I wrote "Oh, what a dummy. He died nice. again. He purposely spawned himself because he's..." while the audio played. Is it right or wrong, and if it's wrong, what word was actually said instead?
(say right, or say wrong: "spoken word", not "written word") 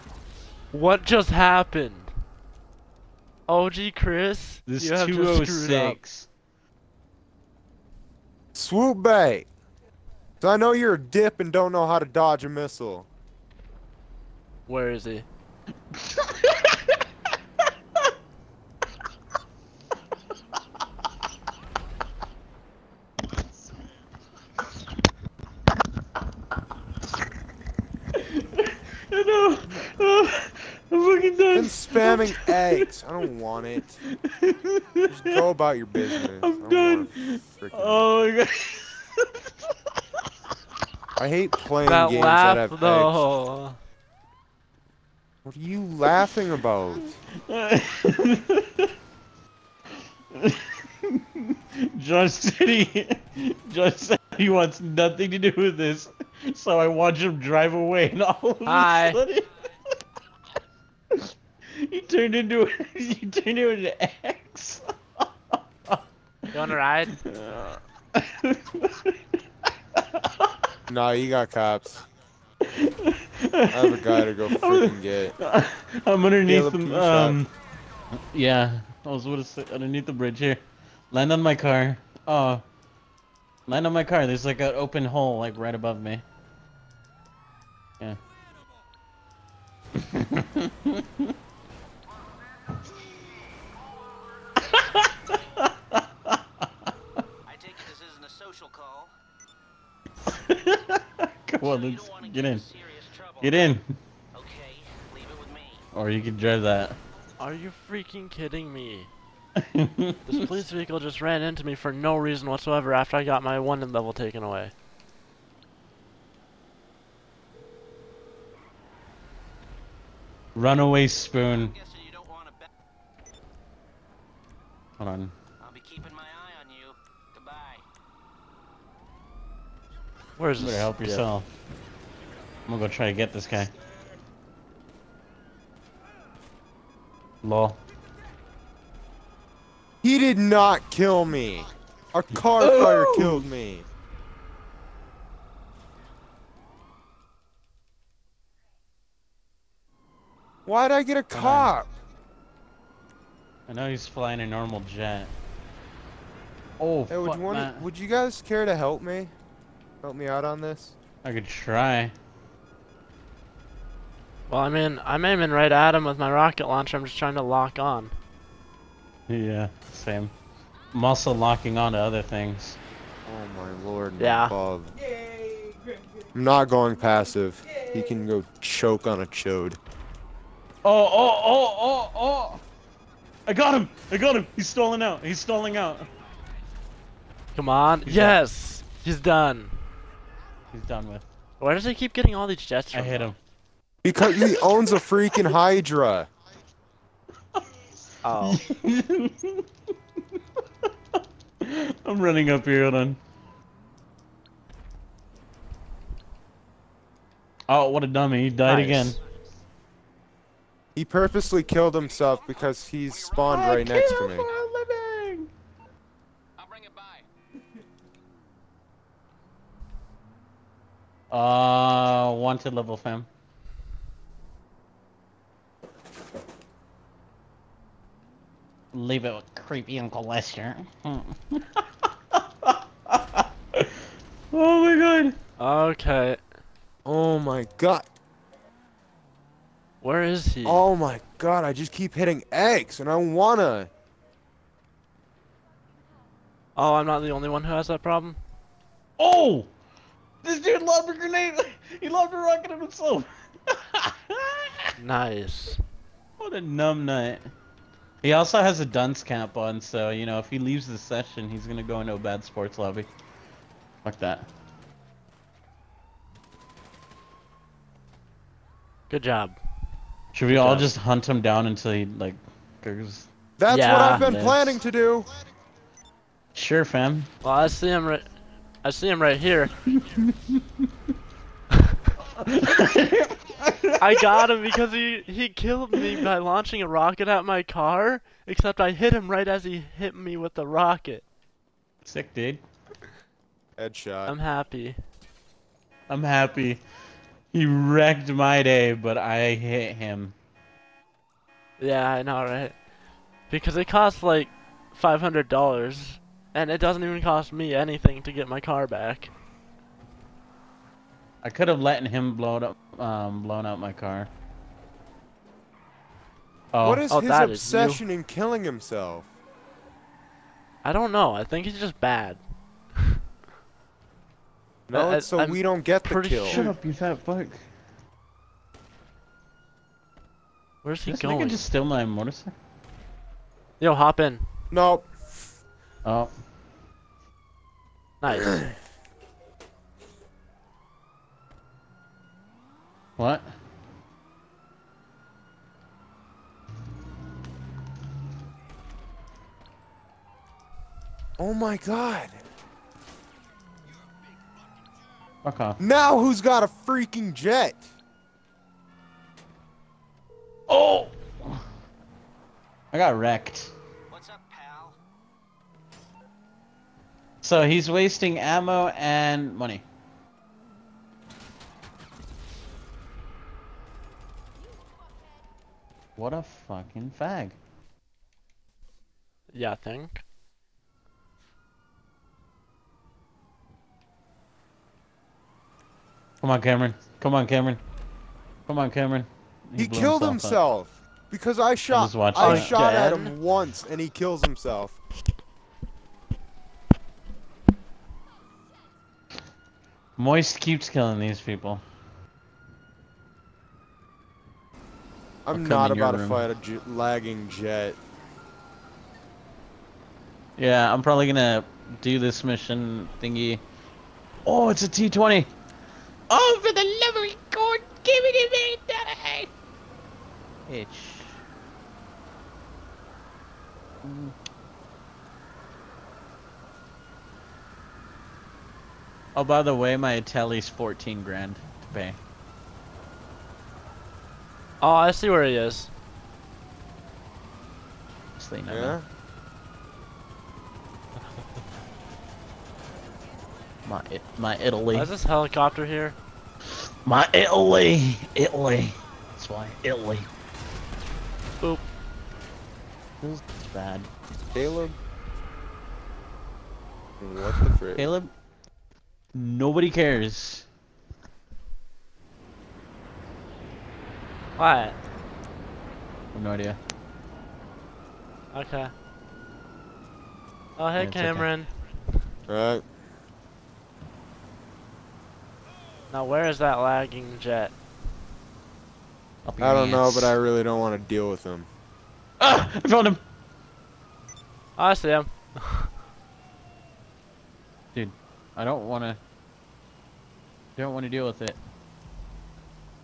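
wrong: "killed", not "spawned".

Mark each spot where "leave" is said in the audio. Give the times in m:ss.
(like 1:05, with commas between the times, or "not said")
1:45, 3:48, 4:20.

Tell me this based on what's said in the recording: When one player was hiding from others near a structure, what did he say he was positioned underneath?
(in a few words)
the bridge.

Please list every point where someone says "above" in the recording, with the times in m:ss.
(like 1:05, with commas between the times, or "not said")
1:25.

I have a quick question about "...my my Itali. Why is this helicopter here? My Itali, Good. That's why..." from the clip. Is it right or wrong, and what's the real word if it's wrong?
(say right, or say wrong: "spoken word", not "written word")
wrong: "Italy", not "Good".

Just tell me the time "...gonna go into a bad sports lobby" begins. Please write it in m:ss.
4:21.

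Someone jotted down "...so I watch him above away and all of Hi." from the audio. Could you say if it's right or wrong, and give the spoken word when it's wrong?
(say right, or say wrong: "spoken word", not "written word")
wrong: "drive", not "above".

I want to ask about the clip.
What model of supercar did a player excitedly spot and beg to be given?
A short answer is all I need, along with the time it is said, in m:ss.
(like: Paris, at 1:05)
T20, at 6:54.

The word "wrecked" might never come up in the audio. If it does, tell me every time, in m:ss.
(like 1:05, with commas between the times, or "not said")
4:57, 6:03.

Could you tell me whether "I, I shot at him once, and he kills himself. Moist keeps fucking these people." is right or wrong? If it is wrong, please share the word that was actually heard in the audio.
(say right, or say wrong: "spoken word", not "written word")
wrong: "killing", not "fucking".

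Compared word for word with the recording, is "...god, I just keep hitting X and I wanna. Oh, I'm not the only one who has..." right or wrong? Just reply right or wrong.
right.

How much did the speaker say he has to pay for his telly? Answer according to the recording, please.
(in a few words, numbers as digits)
14 grand.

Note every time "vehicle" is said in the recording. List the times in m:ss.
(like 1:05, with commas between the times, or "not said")
1:50.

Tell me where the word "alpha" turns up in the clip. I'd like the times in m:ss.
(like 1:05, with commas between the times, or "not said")
not said.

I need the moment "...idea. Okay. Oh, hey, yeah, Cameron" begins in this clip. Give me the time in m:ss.
7:46.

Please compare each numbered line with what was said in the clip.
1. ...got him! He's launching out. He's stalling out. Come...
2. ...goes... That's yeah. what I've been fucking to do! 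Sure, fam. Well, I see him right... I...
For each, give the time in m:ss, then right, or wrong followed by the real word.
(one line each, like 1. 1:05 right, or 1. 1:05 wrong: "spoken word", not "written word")
1. 3:04 wrong: "stalling", not "launching"
2. 4:32 wrong: "planning", not "fucking".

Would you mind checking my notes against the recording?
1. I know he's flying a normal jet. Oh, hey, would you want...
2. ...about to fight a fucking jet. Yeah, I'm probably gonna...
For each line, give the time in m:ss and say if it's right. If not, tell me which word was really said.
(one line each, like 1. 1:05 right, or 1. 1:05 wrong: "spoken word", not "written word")
1. 2:33 right
2. 6:45 wrong: "lagging", not "fucking".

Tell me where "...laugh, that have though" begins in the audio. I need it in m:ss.
0:42.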